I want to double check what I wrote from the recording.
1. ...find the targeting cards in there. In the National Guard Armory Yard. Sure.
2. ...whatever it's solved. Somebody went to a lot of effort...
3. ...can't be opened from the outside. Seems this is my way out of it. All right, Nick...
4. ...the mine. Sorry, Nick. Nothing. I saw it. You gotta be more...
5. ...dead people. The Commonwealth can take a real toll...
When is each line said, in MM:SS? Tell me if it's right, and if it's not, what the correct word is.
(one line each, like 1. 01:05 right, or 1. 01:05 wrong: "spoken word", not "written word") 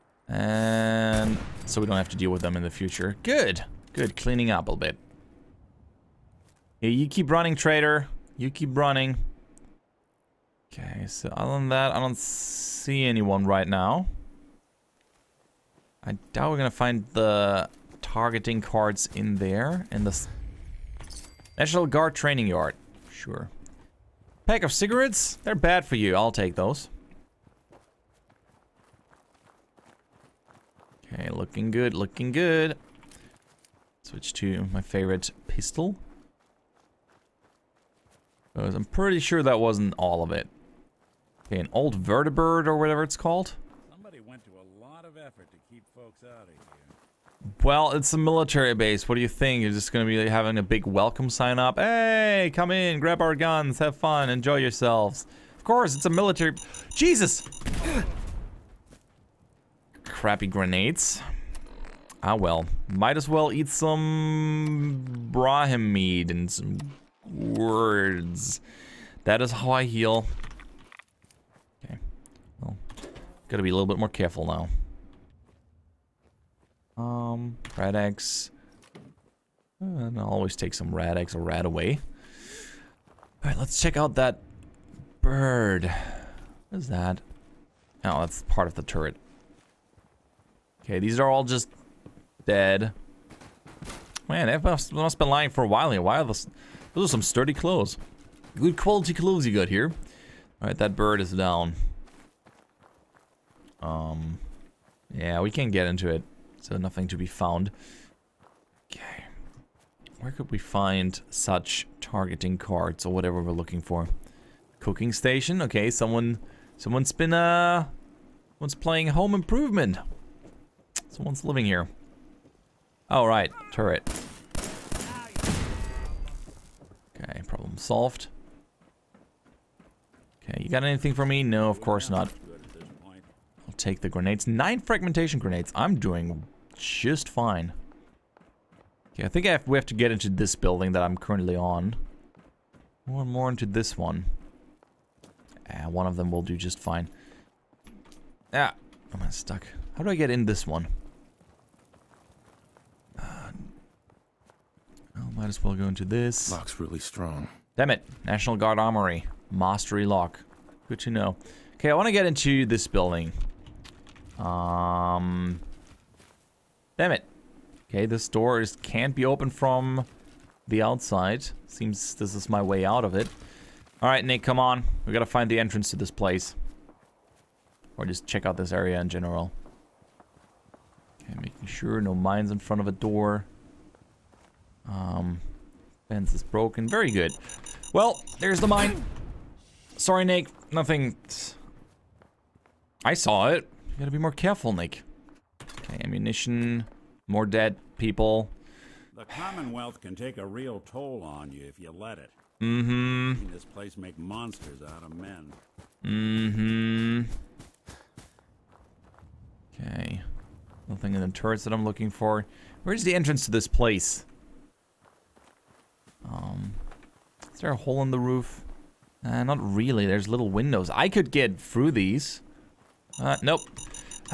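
1. 00:16 wrong: "Training", not "Armory"
2. 00:42 wrong: "called", not "solved"
3. 02:48 right
4. 03:08 right
5. 03:17 right.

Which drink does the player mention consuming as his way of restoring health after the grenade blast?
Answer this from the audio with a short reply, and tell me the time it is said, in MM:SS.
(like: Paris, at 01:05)
Brahmin mead, at 01:05.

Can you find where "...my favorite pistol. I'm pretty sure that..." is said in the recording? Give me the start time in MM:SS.
00:34.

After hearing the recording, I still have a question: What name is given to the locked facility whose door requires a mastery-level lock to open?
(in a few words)
National Guard Armory.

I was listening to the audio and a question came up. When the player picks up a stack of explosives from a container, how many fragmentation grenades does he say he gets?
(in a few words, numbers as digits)
9.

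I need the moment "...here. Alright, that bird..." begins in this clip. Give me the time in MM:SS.
01:39.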